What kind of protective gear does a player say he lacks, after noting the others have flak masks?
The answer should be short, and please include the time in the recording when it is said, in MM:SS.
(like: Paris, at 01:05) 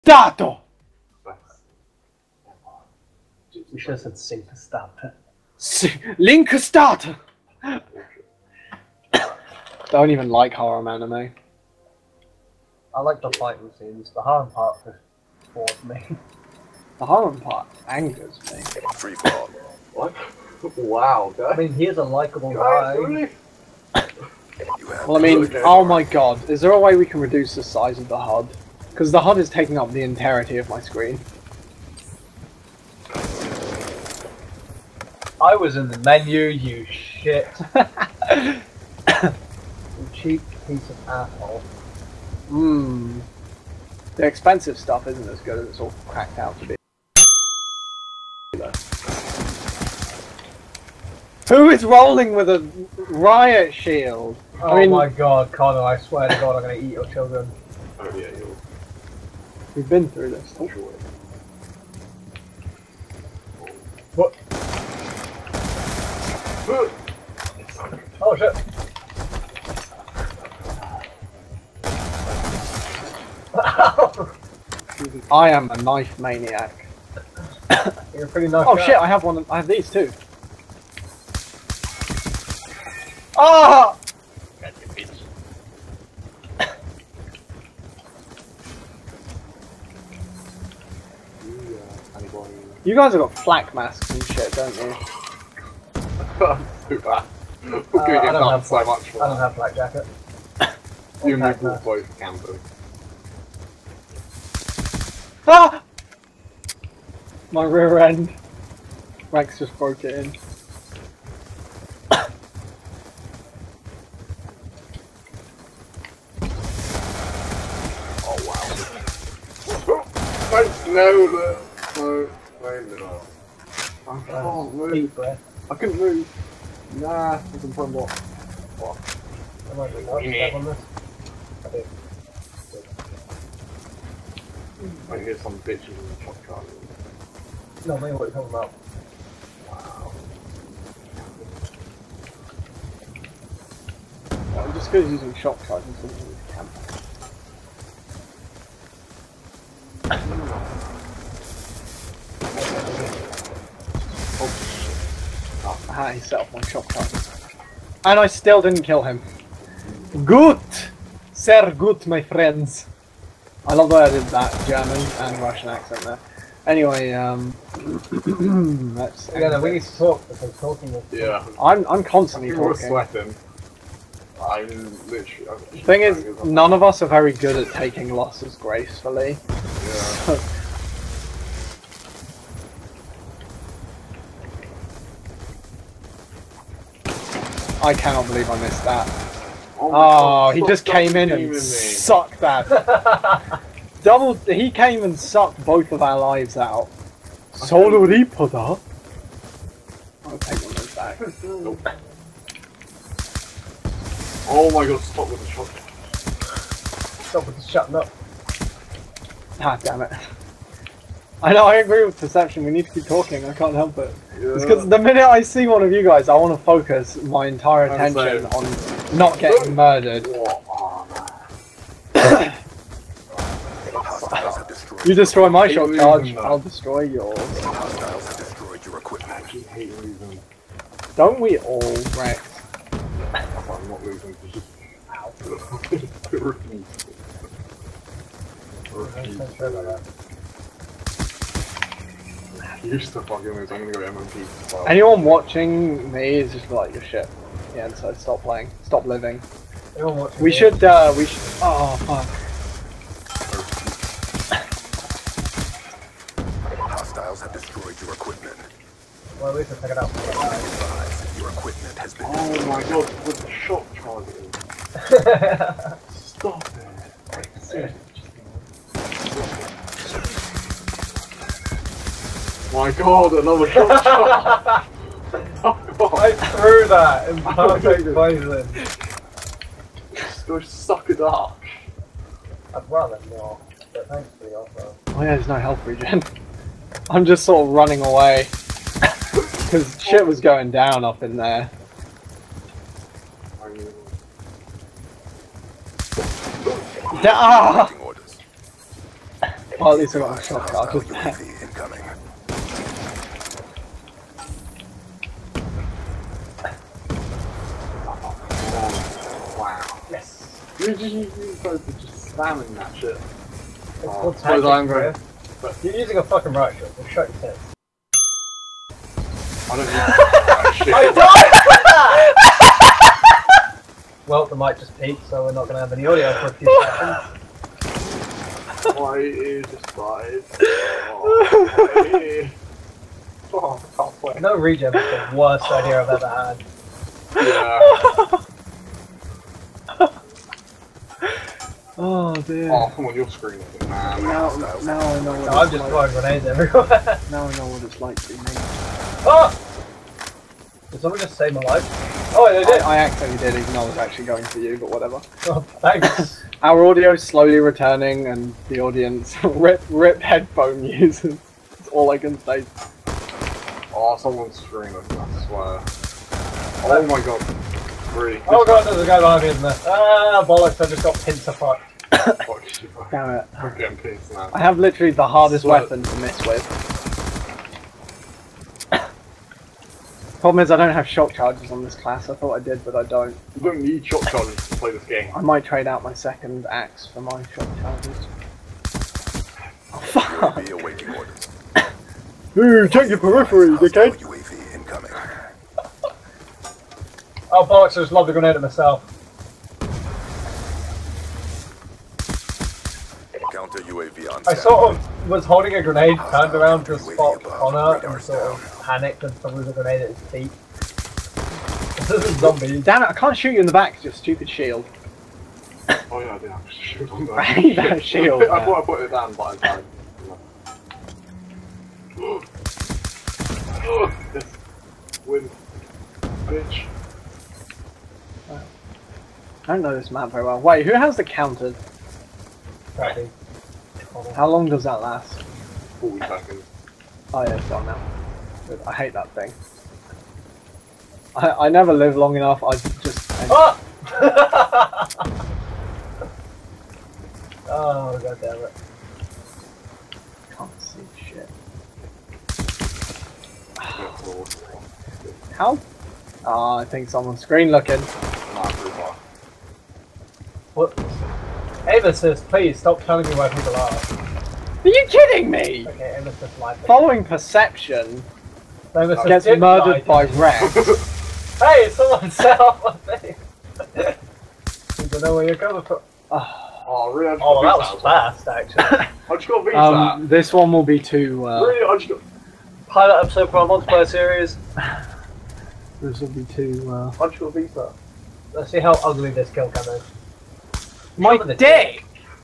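flak jacket, at 01:39.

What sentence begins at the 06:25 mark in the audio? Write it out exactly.
I might trade out my second axe for my shock charges.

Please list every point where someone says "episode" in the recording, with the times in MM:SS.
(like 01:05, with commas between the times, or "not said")
08:03.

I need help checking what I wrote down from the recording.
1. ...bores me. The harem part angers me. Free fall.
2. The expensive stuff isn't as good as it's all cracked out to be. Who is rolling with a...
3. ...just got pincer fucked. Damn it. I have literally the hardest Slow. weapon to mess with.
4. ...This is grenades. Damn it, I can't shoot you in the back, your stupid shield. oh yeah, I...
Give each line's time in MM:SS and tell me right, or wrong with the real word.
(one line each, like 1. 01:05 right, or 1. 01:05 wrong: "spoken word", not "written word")
1. 00:15 right
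2. 00:44 right
3. 06:10 right
4. 06:52 wrong: "zombies", not "grenades".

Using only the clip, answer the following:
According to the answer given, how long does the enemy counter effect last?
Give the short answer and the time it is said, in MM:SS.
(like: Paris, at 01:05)
40, at 07:16.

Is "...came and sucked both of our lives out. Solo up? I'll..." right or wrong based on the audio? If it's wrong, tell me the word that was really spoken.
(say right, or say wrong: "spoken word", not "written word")
right.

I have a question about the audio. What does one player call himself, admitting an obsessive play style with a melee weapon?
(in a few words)
knife maniac.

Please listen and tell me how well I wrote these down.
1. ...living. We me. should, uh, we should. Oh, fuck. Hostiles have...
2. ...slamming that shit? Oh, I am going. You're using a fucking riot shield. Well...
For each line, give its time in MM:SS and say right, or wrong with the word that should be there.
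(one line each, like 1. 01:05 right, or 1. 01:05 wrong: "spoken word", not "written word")
1. 04:09 right
2. 05:12 right.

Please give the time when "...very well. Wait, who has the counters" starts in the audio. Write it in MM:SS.
07:10.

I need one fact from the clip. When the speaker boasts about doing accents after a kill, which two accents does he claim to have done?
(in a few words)
German and Russian.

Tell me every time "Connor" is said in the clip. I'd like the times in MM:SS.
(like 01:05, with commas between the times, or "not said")
00:55, 06:47.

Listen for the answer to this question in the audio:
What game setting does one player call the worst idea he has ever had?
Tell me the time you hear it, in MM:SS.
05:34.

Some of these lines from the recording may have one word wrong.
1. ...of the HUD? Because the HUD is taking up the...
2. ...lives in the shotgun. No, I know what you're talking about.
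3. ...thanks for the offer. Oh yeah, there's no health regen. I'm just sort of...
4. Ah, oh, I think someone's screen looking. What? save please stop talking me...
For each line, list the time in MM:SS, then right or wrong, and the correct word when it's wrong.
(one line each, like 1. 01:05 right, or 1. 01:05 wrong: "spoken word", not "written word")
1. 00:27 right
2. 02:15 wrong: "bitches", not "lives"
3. 04:44 right
4. 07:36 wrong: "telling", not "talking".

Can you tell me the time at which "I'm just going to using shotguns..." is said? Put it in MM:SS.
02:24.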